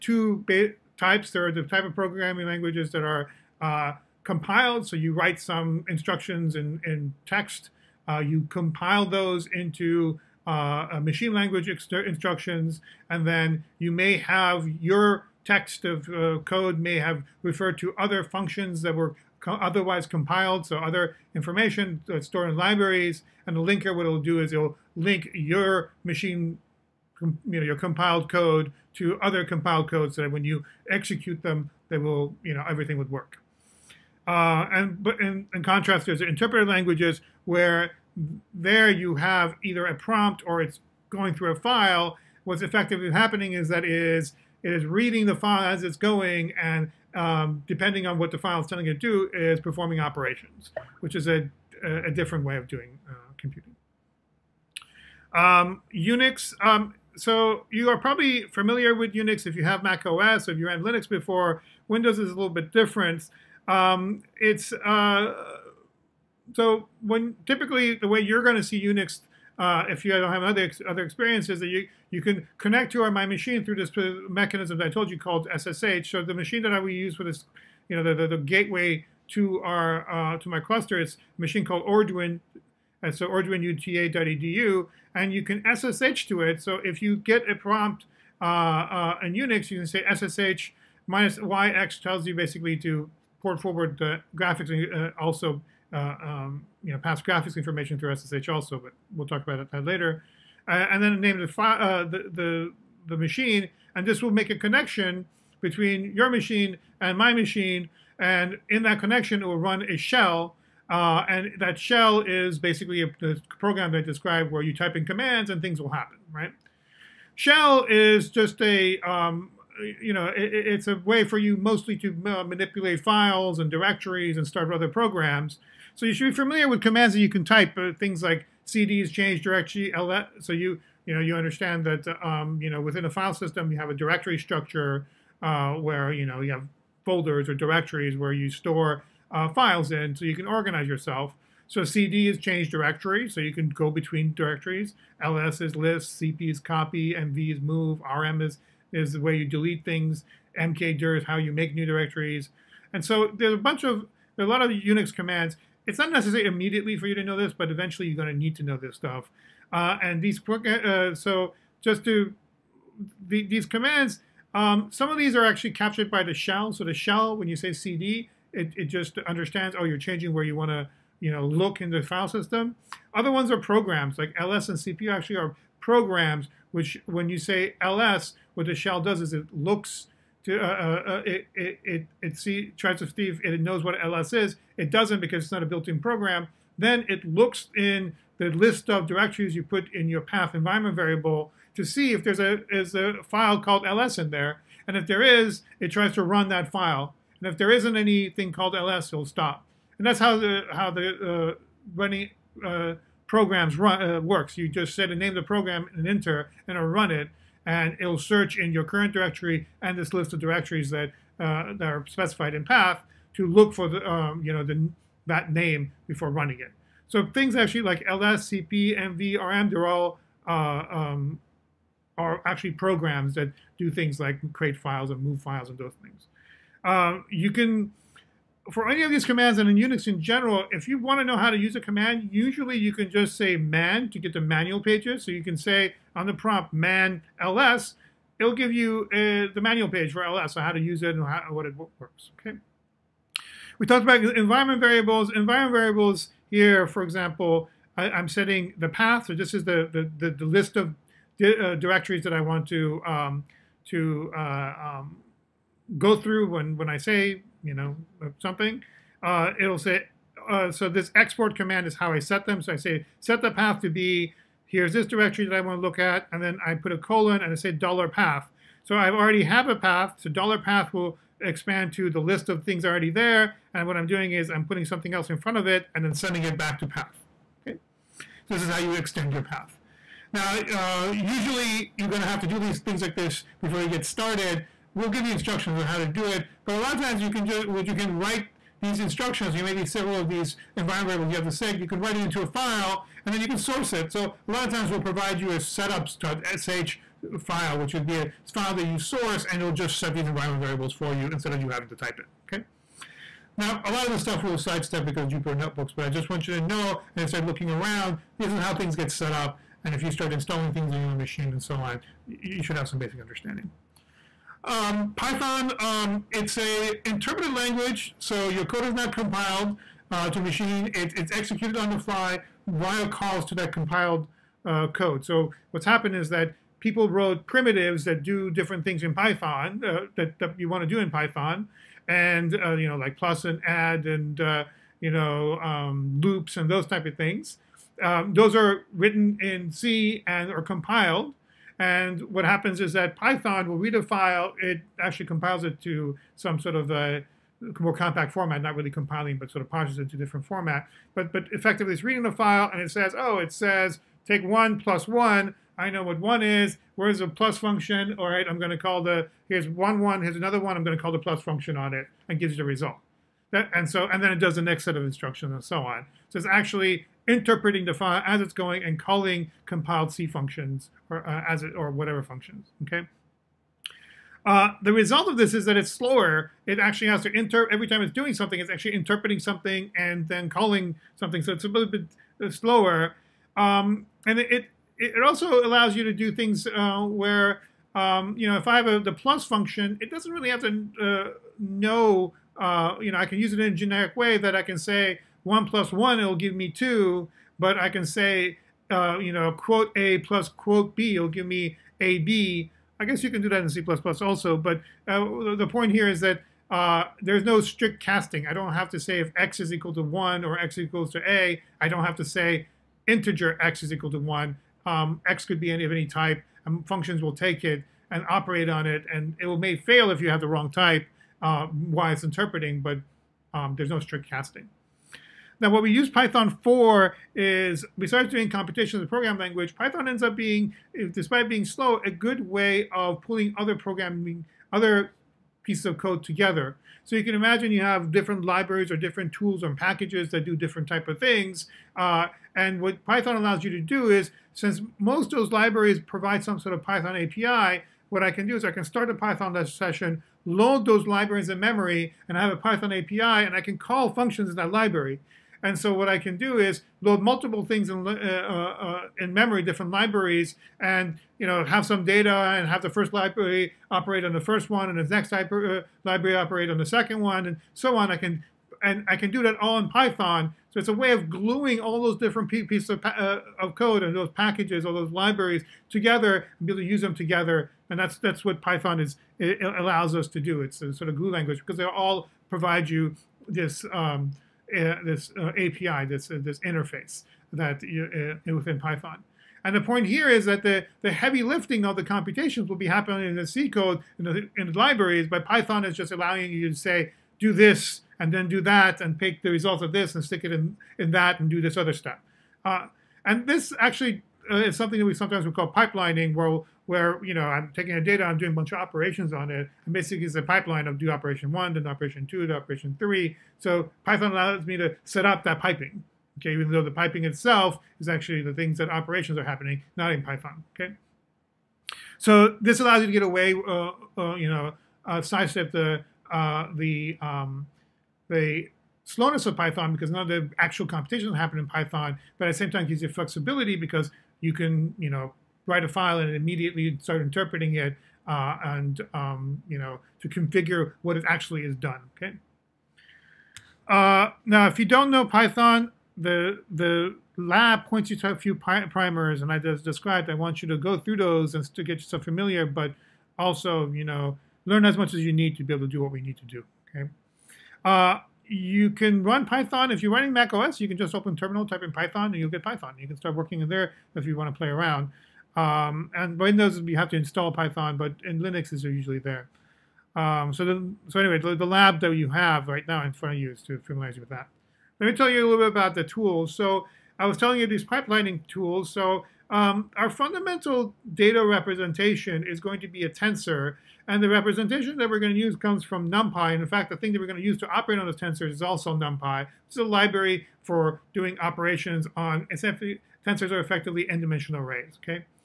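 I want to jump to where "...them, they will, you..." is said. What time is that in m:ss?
0:31.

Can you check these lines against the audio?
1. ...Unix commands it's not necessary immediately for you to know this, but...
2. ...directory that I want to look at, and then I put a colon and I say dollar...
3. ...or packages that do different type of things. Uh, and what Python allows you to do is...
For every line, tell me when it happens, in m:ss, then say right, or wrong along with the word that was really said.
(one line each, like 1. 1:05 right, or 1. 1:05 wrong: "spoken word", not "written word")
1. 2:34 right
2. 4:25 right
3. 7:19 right.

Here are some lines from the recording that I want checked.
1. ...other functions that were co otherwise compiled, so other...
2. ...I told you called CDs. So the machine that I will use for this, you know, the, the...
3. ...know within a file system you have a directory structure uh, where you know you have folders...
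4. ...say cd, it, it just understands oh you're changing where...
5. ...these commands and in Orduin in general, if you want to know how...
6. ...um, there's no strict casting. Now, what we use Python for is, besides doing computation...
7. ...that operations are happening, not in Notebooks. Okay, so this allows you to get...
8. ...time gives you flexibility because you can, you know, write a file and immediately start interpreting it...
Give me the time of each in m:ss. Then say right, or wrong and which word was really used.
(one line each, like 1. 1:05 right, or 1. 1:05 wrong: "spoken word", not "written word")
1. 0:17 right
2. 1:14 wrong: "SSH", not "CDs"
3. 2:12 right
4. 2:47 right
5. 3:49 wrong: "Unix", not "Orduin"
6. 7:03 right
7. 8:38 wrong: "Python", not "Notebooks"
8. 8:52 right.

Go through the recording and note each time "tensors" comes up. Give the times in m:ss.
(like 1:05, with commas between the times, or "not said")
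9:43, 9:48, 9:53.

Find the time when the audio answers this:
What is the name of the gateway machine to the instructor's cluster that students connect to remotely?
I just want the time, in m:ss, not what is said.
1:21.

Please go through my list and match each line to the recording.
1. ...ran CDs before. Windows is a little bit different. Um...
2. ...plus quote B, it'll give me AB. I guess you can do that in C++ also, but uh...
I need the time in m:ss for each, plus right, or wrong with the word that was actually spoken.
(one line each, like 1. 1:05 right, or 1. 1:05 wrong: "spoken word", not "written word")
1. 1:00 wrong: "Linux", not "CDs"
2. 6:40 right.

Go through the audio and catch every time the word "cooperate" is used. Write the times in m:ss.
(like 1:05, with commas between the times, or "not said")
not said.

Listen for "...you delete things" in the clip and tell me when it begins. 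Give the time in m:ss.
2:29.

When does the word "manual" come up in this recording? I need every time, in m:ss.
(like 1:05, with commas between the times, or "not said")
3:54, 3:59.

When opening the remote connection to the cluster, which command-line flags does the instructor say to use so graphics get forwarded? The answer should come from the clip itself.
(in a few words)
-YX.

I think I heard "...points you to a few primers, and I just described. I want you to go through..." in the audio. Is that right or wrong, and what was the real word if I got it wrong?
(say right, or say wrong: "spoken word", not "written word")
right.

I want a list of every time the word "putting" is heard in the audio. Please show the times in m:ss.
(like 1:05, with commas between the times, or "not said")
4:34.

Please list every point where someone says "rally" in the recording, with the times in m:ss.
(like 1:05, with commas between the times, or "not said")
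not said.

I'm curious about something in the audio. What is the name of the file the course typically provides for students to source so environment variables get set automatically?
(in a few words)
setups.sh.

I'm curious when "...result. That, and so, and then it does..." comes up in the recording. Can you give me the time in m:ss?
6:02.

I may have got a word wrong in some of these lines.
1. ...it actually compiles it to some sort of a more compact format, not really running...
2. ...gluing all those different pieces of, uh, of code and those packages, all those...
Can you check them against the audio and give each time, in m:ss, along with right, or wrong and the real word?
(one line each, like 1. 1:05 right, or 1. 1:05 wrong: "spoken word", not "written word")
1. 5:44 wrong: "compiling", not "running"
2. 7:51 right.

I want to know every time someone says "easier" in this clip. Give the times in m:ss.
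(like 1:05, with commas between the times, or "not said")
not said.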